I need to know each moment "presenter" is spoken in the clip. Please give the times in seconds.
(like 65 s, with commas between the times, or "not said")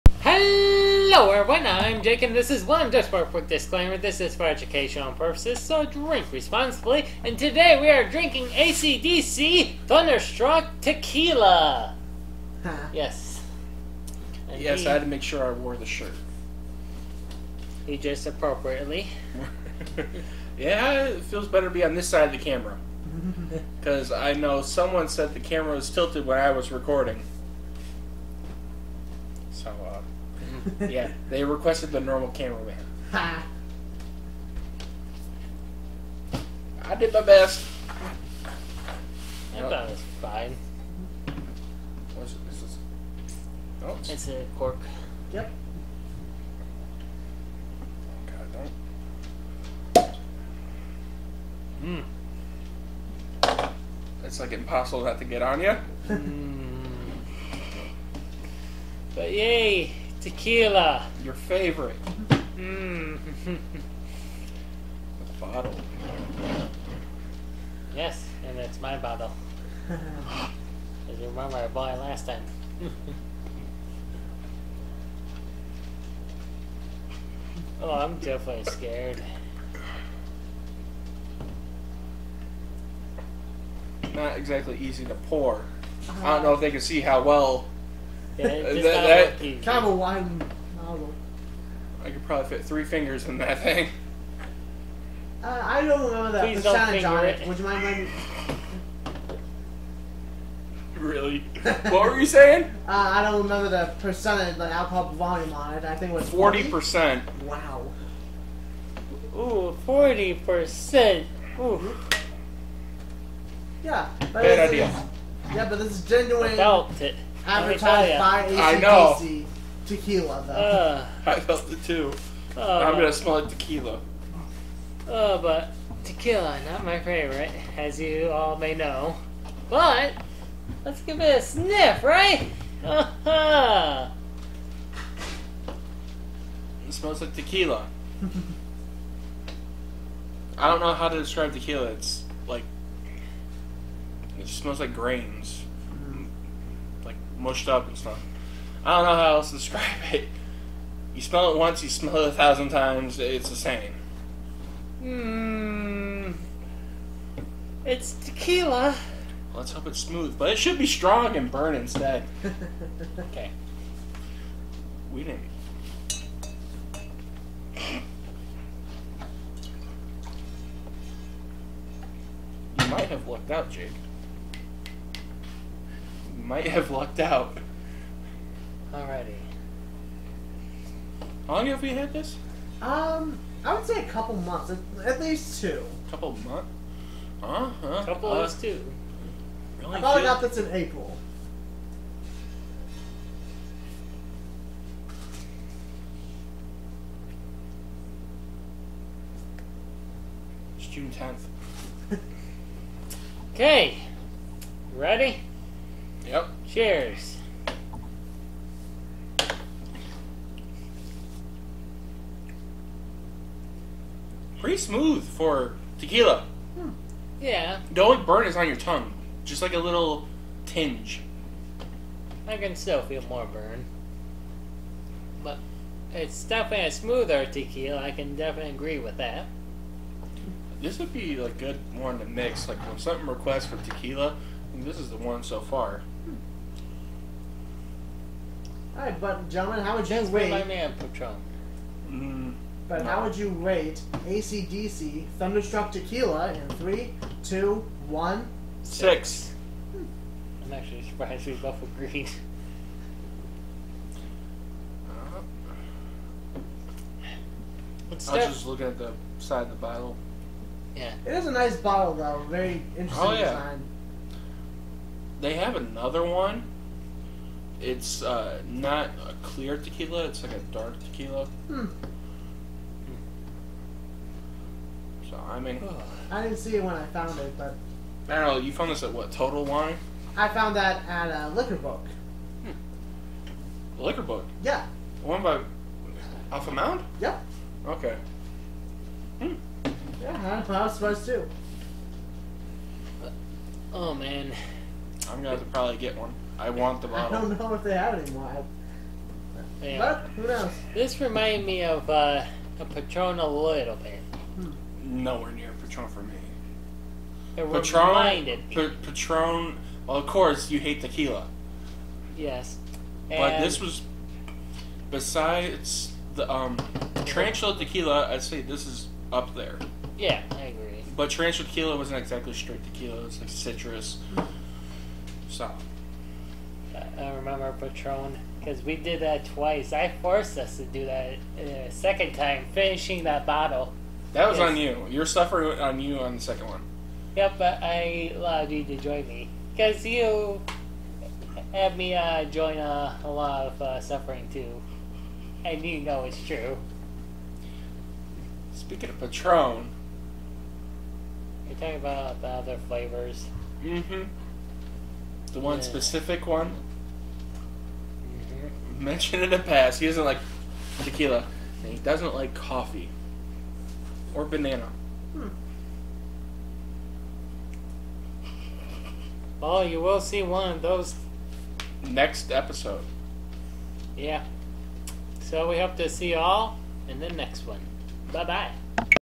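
not said.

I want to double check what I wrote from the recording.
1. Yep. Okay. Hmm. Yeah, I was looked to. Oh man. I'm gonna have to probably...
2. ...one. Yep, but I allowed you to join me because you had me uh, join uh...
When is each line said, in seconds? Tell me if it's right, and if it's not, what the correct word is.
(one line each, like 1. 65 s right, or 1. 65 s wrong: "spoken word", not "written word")
1. 287 s wrong: "supposed", not "looked"
2. 336 s right.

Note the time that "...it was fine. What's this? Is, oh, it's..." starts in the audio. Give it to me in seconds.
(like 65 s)
39 s.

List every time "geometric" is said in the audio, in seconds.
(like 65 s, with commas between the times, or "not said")
not said.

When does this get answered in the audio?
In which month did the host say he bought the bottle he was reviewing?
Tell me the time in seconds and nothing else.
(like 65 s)
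190 s.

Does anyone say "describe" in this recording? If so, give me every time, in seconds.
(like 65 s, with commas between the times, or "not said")
141 s, 149 s.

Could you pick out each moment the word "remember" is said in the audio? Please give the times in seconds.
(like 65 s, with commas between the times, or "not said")
71 s, 96 s, 103 s, 327 s.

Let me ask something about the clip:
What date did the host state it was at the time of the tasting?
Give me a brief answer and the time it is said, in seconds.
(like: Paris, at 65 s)
June 10, at 200 s.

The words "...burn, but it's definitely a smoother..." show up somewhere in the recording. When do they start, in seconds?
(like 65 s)
223 s.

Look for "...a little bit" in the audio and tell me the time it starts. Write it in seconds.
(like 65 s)
303 s.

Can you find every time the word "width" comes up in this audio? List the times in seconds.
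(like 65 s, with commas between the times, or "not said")
not said.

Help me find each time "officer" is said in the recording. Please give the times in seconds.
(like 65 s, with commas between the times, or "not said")
not said.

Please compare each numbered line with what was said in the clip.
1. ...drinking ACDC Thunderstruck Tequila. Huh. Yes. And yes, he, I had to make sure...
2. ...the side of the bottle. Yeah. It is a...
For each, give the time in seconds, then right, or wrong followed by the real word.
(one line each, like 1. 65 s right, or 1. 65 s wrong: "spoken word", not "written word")
1. 8 s right
2. 258 s right.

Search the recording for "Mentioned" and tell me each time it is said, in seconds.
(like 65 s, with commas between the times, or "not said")
359 s.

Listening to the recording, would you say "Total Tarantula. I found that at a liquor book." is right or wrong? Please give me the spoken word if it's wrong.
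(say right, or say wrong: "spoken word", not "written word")
wrong: "Wine", not "Tarantula".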